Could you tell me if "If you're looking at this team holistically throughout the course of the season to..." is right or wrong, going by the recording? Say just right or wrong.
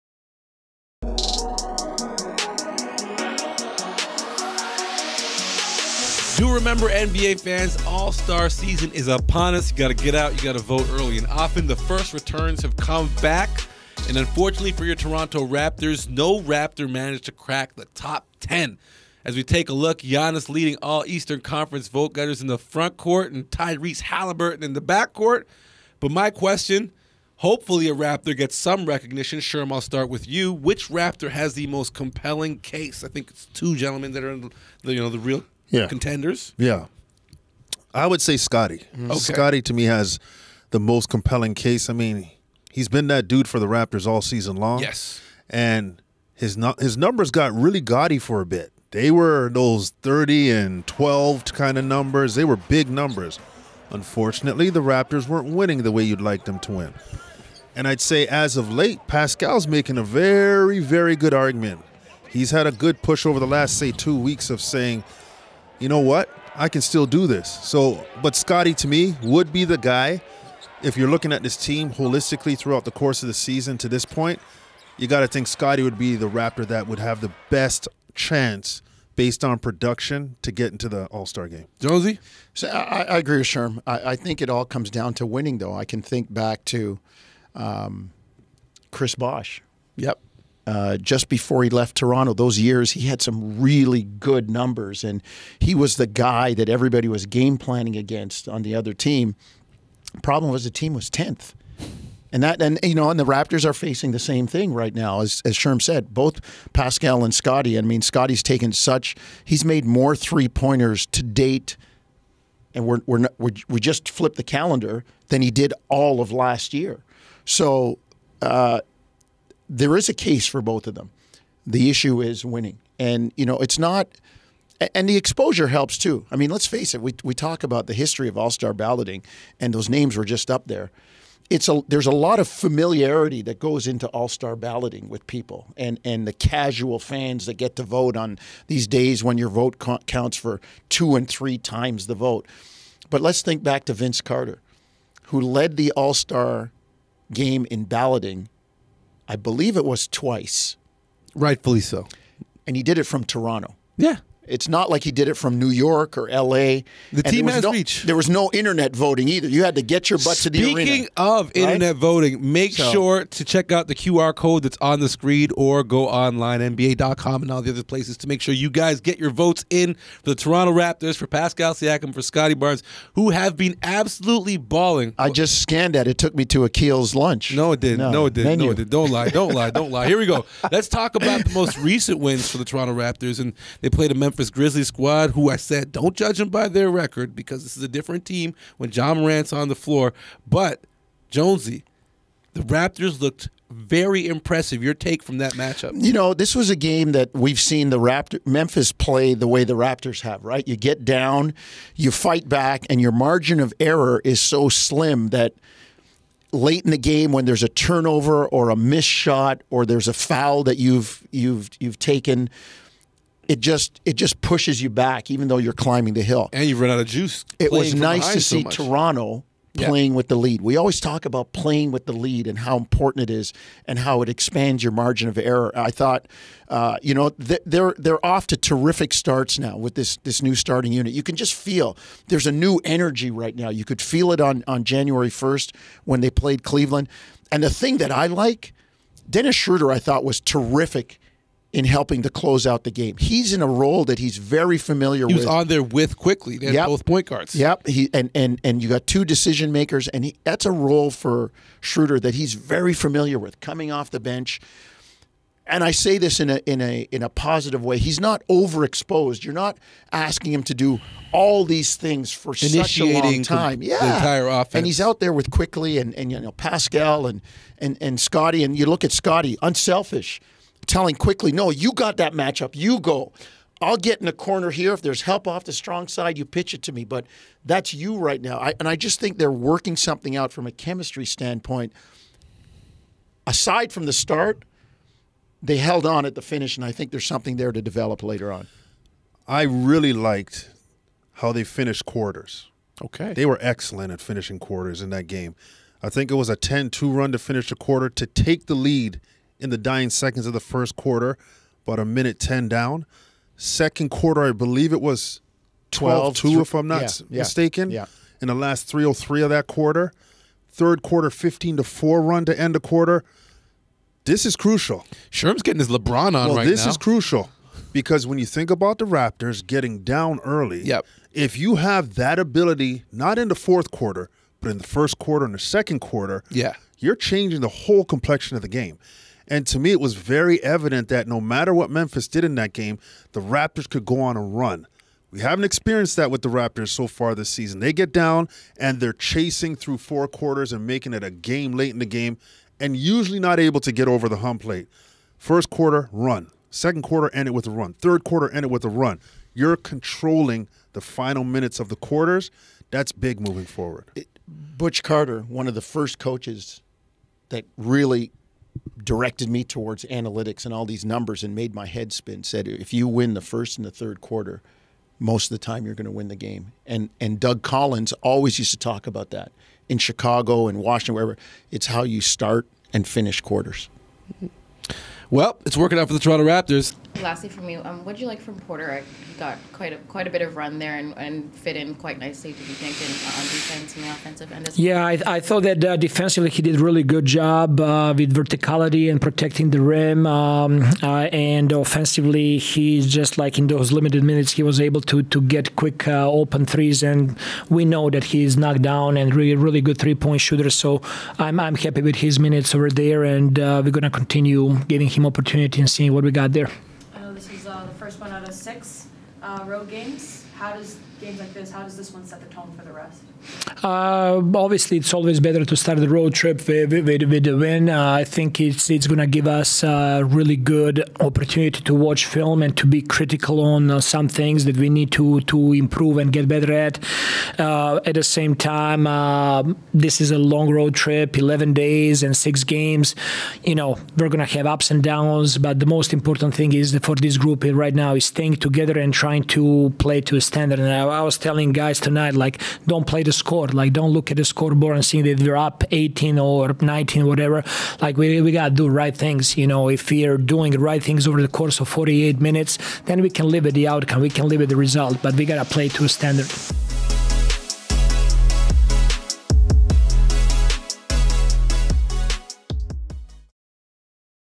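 right.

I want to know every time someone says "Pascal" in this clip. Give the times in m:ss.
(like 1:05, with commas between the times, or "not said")
0:59, 1:46, 2:51, 4:26.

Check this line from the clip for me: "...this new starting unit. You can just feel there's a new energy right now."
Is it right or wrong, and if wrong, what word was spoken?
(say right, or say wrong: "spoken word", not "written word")
right.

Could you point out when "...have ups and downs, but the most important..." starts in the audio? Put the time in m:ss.
7:14.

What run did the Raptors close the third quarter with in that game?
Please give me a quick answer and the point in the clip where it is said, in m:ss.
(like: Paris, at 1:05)
15 to 4, at 5:11.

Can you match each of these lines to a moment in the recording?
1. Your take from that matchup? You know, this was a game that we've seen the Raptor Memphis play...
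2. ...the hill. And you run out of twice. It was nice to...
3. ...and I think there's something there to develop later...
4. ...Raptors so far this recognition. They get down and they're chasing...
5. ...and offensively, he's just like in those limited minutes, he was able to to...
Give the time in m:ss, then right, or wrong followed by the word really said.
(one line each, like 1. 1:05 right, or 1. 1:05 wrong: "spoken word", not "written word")
1. 3:14 right
2. 3:36 wrong: "juice", not "twice"
3. 4:46 right
4. 5:36 wrong: "season", not "recognition"
5. 6:31 right.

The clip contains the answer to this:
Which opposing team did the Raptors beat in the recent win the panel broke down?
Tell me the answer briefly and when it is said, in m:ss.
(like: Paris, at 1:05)
Memphis Grizzlies, at 3:04.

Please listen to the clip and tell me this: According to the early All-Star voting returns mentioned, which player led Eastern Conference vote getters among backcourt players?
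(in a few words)
Tyrese Halliburton.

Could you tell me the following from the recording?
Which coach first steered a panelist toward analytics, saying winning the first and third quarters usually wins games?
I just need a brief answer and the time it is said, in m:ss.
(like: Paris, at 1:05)
Butch Carter, at 5:54.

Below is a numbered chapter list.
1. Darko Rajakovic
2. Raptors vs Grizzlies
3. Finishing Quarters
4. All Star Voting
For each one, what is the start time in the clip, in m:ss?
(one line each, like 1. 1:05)
1. 6:20
2. 3:00
3. 4:50
4. 0:15.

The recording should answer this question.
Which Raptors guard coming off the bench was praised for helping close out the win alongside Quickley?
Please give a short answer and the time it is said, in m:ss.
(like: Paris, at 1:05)
Dennis Schroeder, at 3:59.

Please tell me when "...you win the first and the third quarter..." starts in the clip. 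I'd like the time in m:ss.
6:02.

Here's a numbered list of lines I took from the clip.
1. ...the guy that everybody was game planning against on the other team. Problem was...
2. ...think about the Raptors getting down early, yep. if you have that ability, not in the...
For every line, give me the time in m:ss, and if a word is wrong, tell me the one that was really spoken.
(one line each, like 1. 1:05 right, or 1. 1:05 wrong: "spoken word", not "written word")
1. 1:35 right
2. 5:18 right.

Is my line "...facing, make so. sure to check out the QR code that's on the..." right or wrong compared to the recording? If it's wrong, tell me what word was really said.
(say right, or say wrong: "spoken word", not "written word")
wrong: "voting", not "facing".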